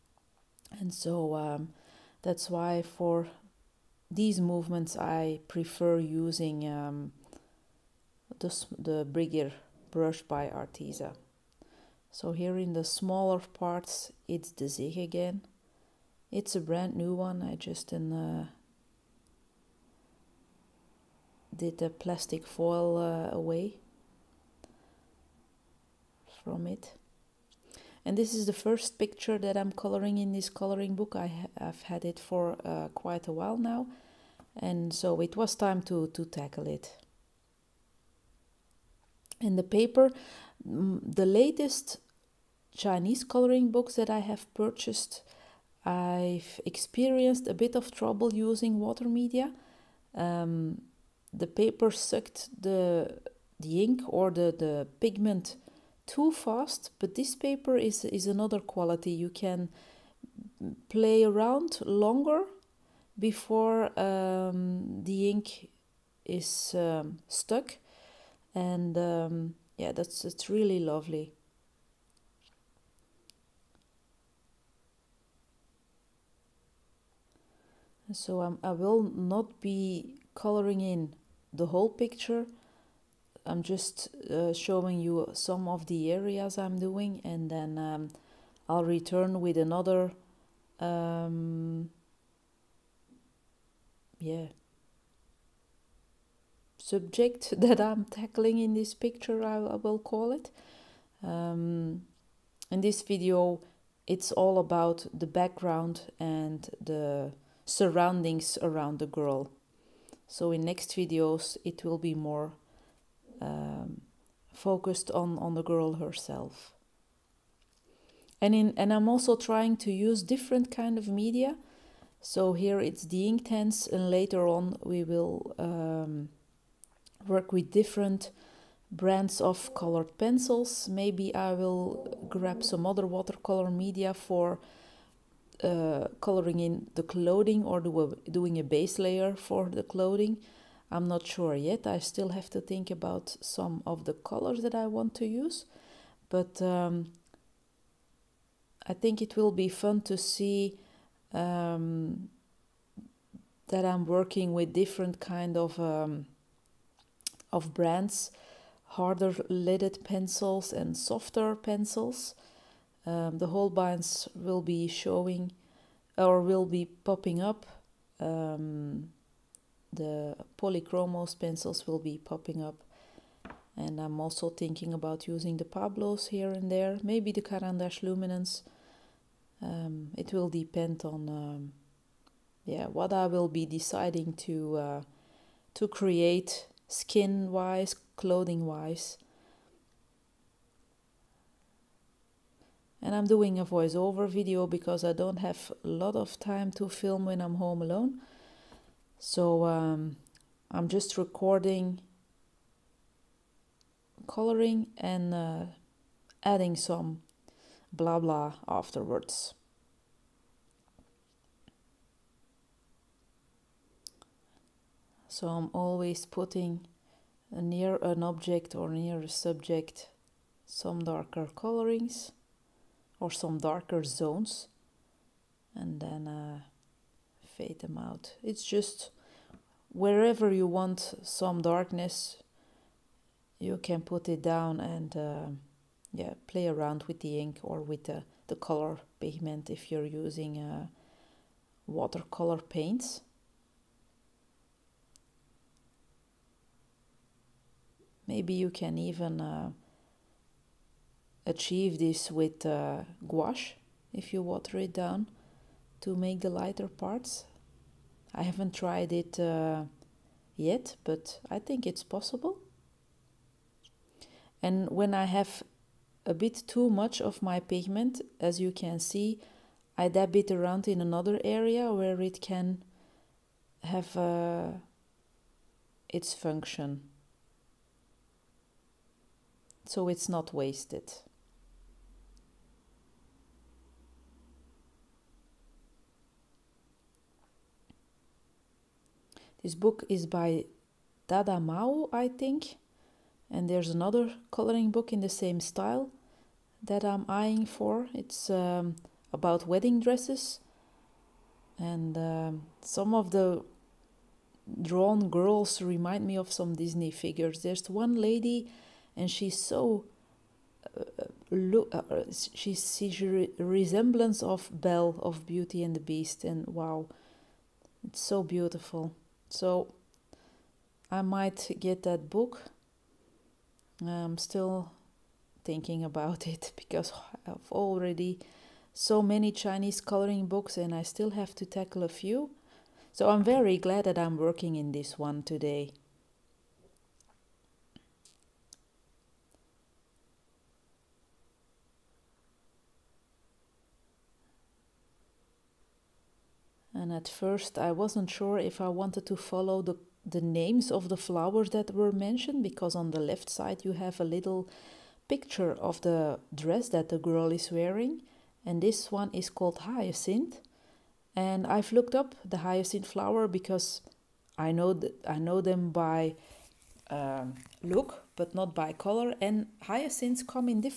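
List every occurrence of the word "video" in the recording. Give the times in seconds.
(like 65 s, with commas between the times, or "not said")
103 s, 110 s, 194 s.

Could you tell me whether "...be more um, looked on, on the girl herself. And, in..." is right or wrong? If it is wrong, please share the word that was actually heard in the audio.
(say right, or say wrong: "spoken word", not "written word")
wrong: "focused", not "looked".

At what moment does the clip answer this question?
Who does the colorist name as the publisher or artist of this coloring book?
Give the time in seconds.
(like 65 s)
291 s.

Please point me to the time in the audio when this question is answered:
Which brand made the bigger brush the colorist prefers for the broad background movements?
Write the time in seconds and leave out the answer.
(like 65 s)
10 s.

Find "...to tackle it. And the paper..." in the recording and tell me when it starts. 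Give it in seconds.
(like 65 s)
36 s.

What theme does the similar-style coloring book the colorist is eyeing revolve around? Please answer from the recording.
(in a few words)
wedding dresses.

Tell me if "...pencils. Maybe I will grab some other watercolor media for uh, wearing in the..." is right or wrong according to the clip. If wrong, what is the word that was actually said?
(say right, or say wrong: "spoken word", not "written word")
wrong: "coloring", not "wearing".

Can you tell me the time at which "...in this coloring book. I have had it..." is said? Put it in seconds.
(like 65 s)
30 s.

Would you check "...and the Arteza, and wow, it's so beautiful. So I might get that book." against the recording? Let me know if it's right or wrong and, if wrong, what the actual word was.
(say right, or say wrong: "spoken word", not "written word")
wrong: "Beast", not "Arteza".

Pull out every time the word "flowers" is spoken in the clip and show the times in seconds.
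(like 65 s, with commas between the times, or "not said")
351 s, 363 s.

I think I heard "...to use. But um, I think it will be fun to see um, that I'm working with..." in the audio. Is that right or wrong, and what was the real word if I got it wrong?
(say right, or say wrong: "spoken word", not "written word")
right.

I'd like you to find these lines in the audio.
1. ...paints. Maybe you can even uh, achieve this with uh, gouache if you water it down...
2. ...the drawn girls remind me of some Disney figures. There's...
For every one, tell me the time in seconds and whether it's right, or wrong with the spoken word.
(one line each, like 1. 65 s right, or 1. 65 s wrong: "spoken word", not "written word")
1. 242 s right
2. 303 s right.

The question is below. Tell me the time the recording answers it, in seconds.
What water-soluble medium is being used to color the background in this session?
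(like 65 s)
123 s.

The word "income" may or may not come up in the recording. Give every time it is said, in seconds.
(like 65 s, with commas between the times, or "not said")
not said.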